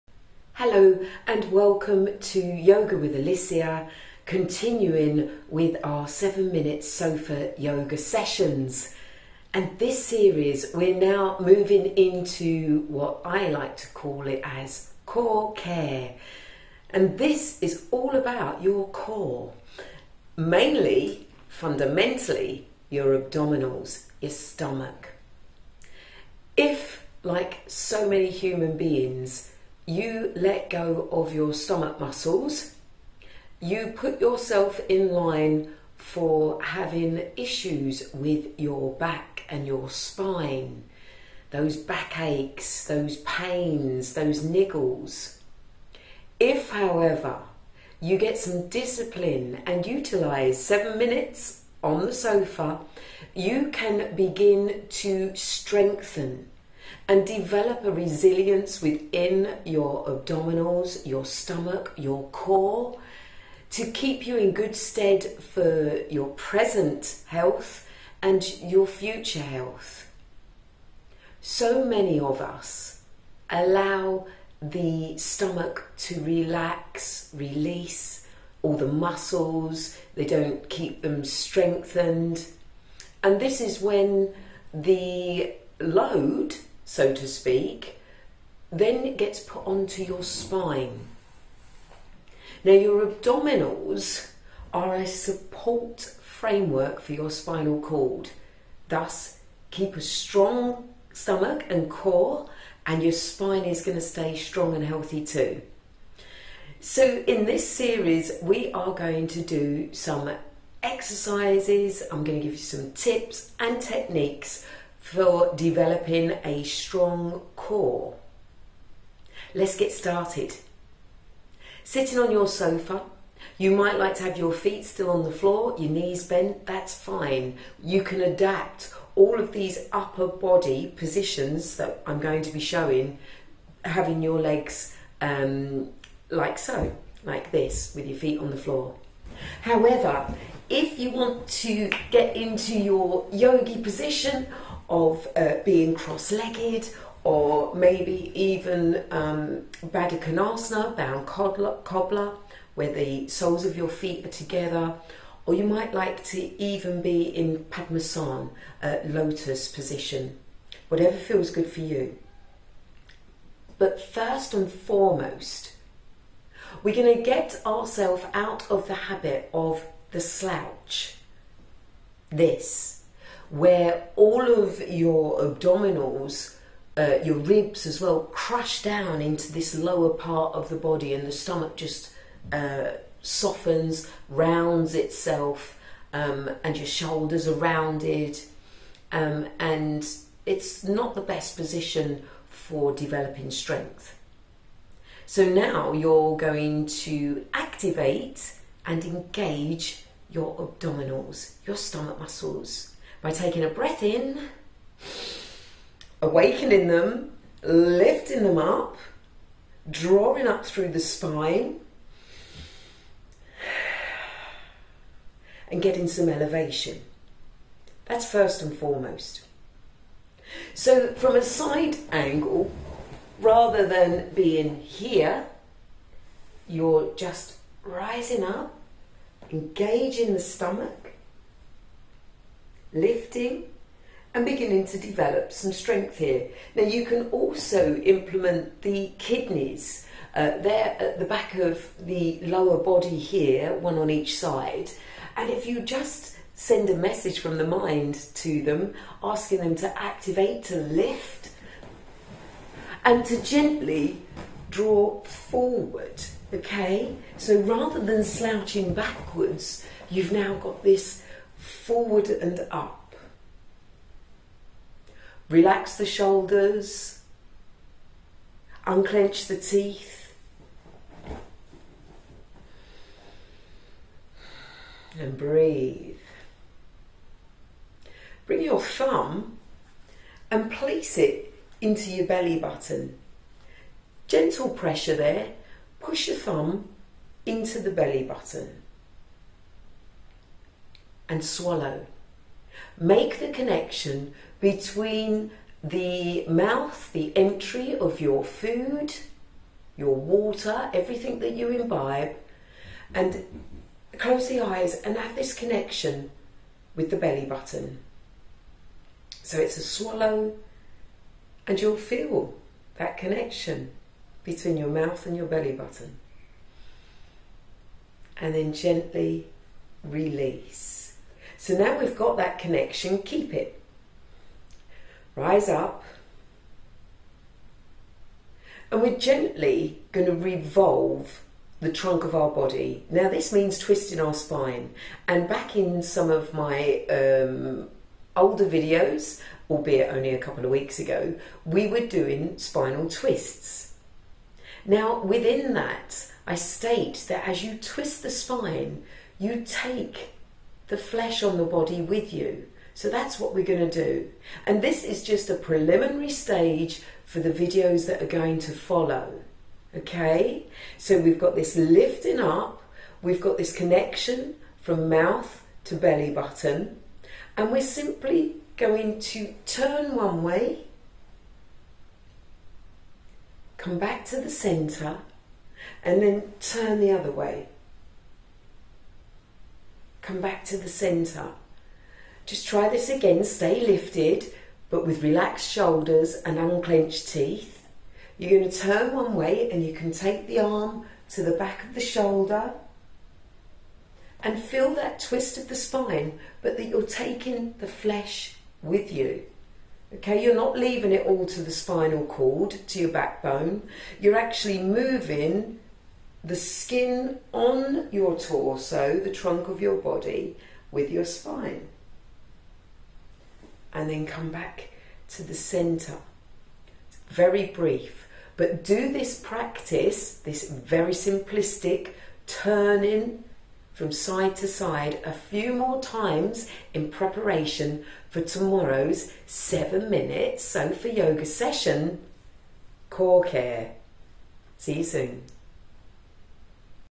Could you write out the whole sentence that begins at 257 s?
So rather than slouching backwards, you've now got this forward and up.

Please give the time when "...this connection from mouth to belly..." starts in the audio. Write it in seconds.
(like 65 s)
363 s.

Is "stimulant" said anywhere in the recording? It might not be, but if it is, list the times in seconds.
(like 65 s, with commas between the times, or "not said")
not said.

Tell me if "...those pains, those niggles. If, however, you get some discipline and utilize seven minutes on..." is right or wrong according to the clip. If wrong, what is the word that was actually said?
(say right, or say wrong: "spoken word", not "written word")
right.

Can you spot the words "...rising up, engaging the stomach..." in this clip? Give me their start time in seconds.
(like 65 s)
227 s.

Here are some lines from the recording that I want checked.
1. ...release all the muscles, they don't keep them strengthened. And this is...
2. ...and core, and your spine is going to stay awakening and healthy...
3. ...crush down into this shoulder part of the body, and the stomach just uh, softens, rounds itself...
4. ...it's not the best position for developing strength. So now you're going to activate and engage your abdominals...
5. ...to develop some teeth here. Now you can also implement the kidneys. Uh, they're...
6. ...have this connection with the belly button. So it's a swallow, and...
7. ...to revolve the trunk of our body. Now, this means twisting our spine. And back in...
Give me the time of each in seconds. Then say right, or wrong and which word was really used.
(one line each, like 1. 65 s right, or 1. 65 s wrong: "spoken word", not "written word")
1. 77 s right
2. 101 s wrong: "strong", not "awakening"
3. 178 s wrong: "lower", not "shoulder"
4. 190 s right
5. 234 s wrong: "strength", not "teeth"
6. 305 s right
7. 330 s right.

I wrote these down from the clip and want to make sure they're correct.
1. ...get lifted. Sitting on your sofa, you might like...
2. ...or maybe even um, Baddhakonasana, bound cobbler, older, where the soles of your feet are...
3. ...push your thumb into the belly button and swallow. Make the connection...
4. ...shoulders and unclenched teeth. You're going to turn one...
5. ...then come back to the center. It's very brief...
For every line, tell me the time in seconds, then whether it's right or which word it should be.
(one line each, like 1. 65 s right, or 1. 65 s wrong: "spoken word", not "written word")
1. 119 s wrong: "started", not "lifted"
2. 147 s wrong: "cobbler", not "older"
3. 285 s right
4. 385 s right
5. 414 s right.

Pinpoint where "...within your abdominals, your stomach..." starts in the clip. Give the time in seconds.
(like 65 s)
58 s.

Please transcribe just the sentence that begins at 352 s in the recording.
So that's what we're going to do.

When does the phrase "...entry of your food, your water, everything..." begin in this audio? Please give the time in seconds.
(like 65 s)
297 s.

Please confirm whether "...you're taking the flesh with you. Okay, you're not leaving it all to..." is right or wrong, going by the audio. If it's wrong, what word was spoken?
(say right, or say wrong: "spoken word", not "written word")
right.